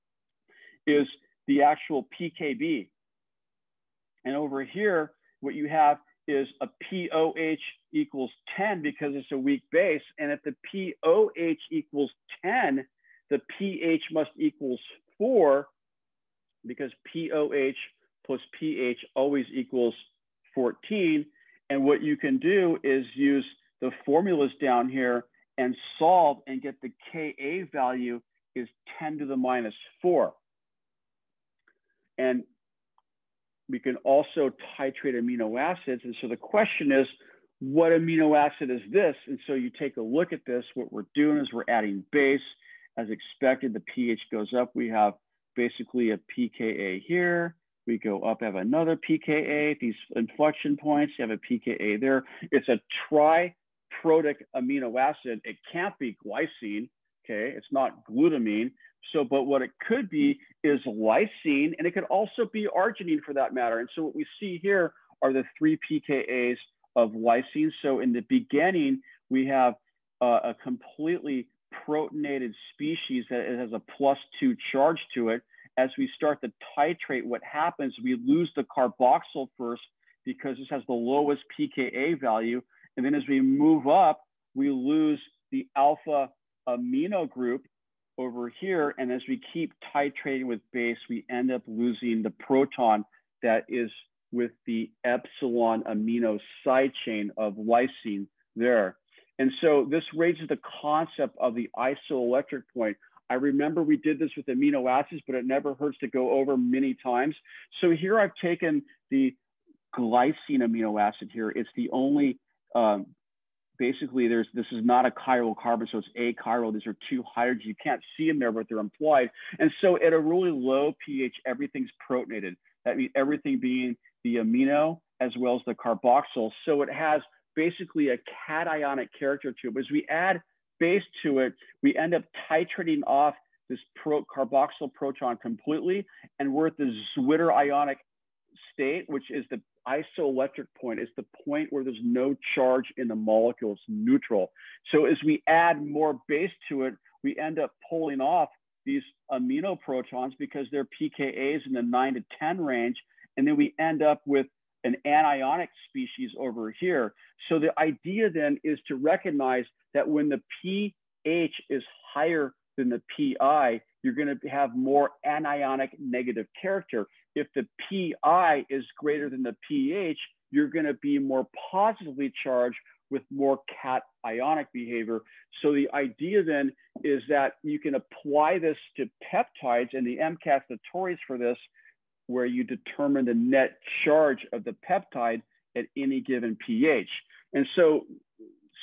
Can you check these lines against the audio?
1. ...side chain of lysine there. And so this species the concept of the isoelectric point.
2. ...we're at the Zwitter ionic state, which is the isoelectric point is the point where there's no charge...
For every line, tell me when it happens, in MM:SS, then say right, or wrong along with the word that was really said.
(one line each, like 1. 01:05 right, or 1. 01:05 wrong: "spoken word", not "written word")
1. 01:36 wrong: "raises", not "species"
2. 02:16 right.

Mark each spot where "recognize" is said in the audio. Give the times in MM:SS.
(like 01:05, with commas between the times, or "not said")
02:38.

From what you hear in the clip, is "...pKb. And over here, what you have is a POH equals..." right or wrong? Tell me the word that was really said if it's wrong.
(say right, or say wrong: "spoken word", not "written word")
right.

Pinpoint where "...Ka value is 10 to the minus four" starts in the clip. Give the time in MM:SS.
00:27.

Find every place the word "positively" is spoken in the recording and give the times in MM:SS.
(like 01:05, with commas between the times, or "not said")
02:51.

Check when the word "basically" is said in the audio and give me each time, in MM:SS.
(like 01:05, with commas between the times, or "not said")
00:45, 01:53, 02:07.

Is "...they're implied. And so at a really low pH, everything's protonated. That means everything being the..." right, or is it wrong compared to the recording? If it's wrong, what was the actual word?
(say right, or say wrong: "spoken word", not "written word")
right.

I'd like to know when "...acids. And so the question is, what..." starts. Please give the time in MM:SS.
00:35.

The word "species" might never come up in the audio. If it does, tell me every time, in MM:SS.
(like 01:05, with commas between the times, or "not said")
01:12, 02:35.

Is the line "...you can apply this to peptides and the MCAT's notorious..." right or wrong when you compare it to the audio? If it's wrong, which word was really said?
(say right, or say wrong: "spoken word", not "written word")
right.